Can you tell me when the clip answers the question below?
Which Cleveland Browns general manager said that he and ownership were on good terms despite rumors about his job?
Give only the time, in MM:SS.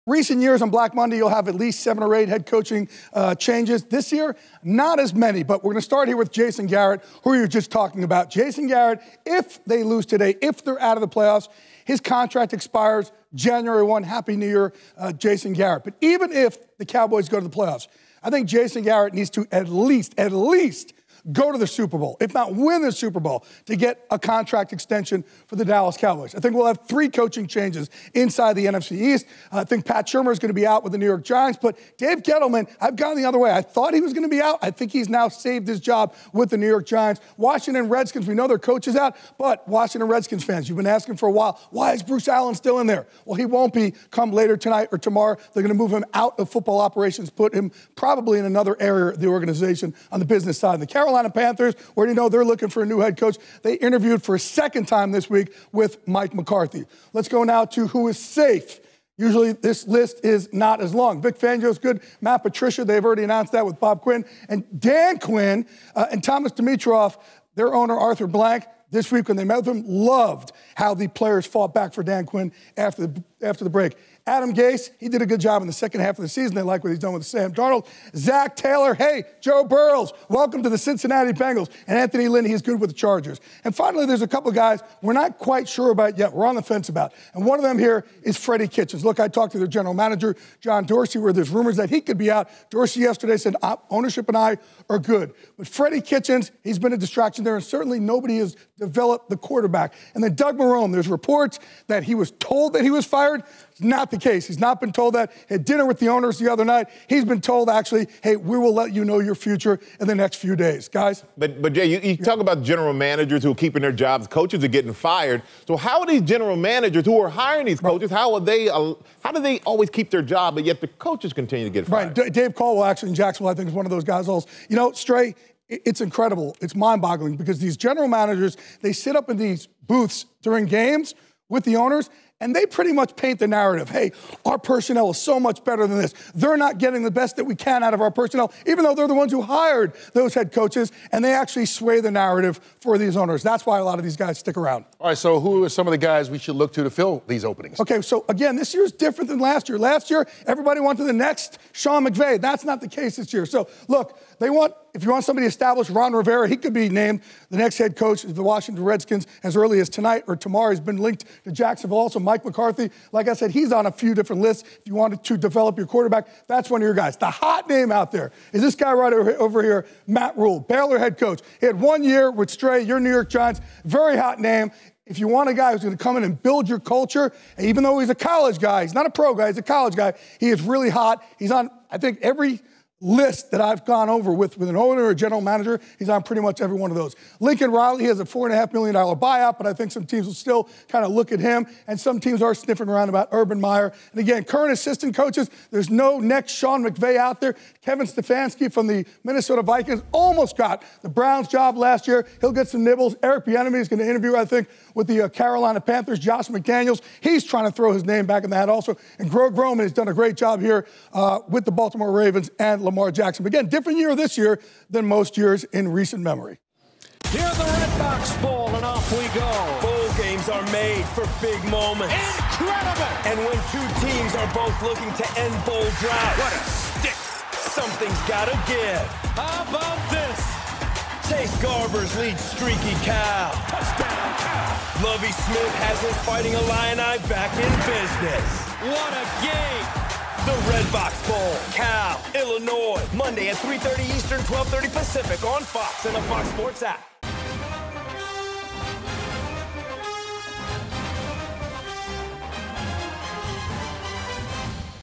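01:30.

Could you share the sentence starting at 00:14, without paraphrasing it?
Happy New Year, uh, Jason Garrett.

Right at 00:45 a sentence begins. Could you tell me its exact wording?
They're going to move him out of football operations, put him probably in another area of the organization on the business side.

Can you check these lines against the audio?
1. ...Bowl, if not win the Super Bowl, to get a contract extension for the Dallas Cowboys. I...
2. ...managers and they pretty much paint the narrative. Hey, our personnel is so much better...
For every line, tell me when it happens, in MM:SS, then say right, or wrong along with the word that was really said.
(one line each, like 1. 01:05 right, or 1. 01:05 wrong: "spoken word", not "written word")
1. 00:21 right
2. 02:11 wrong: "owners", not "managers".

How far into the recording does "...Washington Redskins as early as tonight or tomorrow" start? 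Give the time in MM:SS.
02:38.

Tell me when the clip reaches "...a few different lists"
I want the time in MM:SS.
02:43.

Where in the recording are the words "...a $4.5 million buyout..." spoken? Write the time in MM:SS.
03:08.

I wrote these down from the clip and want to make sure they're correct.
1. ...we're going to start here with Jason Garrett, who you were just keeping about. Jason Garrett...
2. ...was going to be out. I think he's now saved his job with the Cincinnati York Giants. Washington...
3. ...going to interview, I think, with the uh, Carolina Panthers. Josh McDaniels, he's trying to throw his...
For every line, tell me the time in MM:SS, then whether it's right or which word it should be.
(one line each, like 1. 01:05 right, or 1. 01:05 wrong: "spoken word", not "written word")
1. 00:05 wrong: "talking", not "keeping"
2. 00:34 wrong: "New", not "Cincinnati"
3. 03:23 right.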